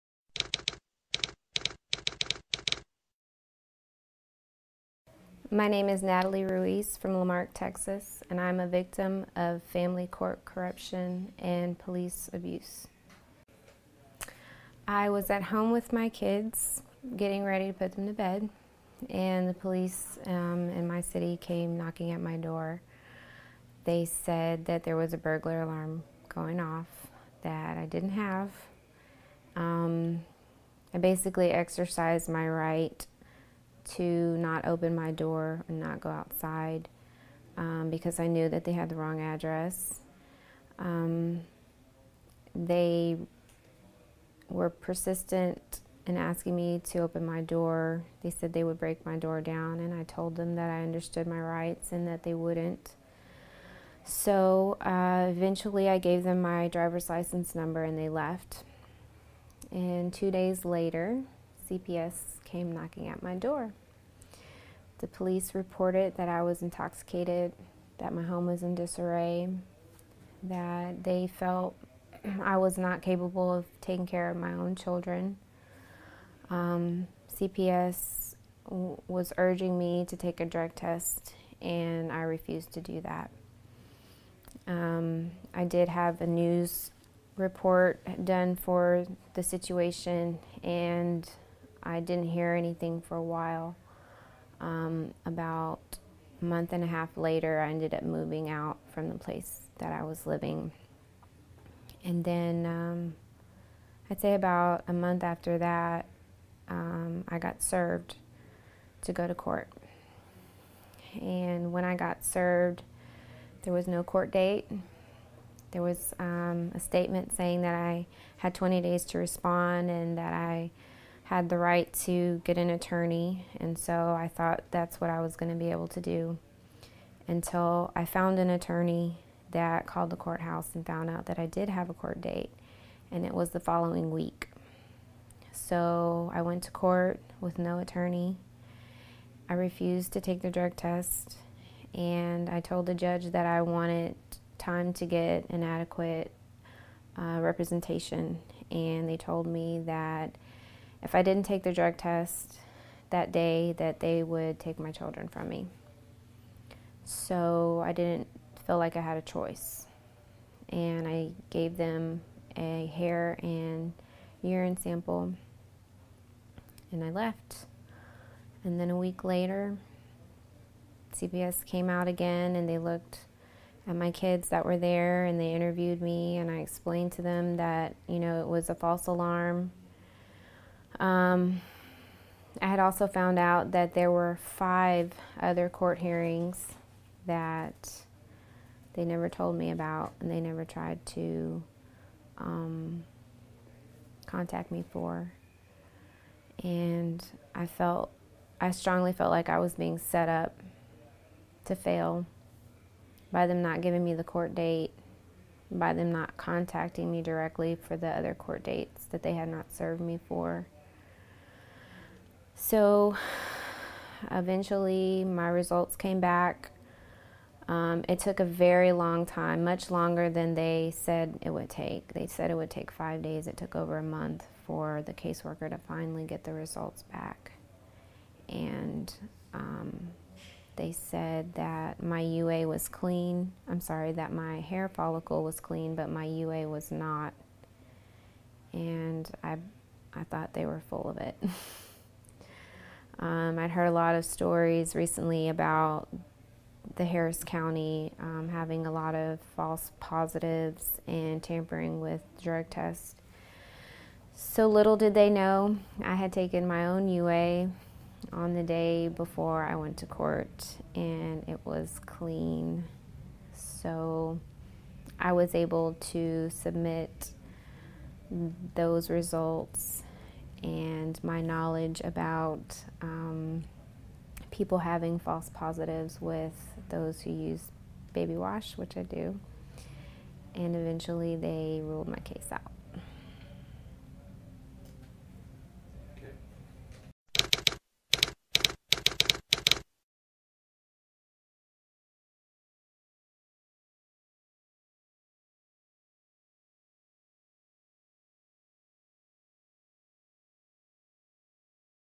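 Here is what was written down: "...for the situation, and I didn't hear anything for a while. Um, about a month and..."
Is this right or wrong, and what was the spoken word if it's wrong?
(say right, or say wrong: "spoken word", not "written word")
right.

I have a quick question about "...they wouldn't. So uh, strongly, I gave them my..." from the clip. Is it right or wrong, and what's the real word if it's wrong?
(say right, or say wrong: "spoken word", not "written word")
wrong: "eventually", not "strongly".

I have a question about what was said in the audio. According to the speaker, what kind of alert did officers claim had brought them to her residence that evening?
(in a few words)
burglar alarm.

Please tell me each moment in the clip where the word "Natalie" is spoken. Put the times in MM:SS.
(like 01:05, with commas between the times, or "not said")
00:06.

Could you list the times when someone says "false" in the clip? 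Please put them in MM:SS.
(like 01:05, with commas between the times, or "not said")
02:58, 04:09, 04:35.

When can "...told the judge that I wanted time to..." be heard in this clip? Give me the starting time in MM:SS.
02:22.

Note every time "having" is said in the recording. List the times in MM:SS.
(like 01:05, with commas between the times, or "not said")
04:08, 04:34.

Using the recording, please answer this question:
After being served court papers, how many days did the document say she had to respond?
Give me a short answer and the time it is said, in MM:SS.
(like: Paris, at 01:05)
20, at 01:58.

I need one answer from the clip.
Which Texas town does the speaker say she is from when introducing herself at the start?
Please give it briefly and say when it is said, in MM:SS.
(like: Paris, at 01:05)
La Marque, at 00:07.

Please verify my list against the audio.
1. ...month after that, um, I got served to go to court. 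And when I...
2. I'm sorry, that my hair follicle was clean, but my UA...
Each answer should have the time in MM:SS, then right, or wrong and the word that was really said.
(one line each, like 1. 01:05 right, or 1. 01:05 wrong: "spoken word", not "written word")
1. 01:44 right
2. 03:53 right.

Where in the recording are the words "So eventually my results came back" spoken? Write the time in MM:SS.
03:32.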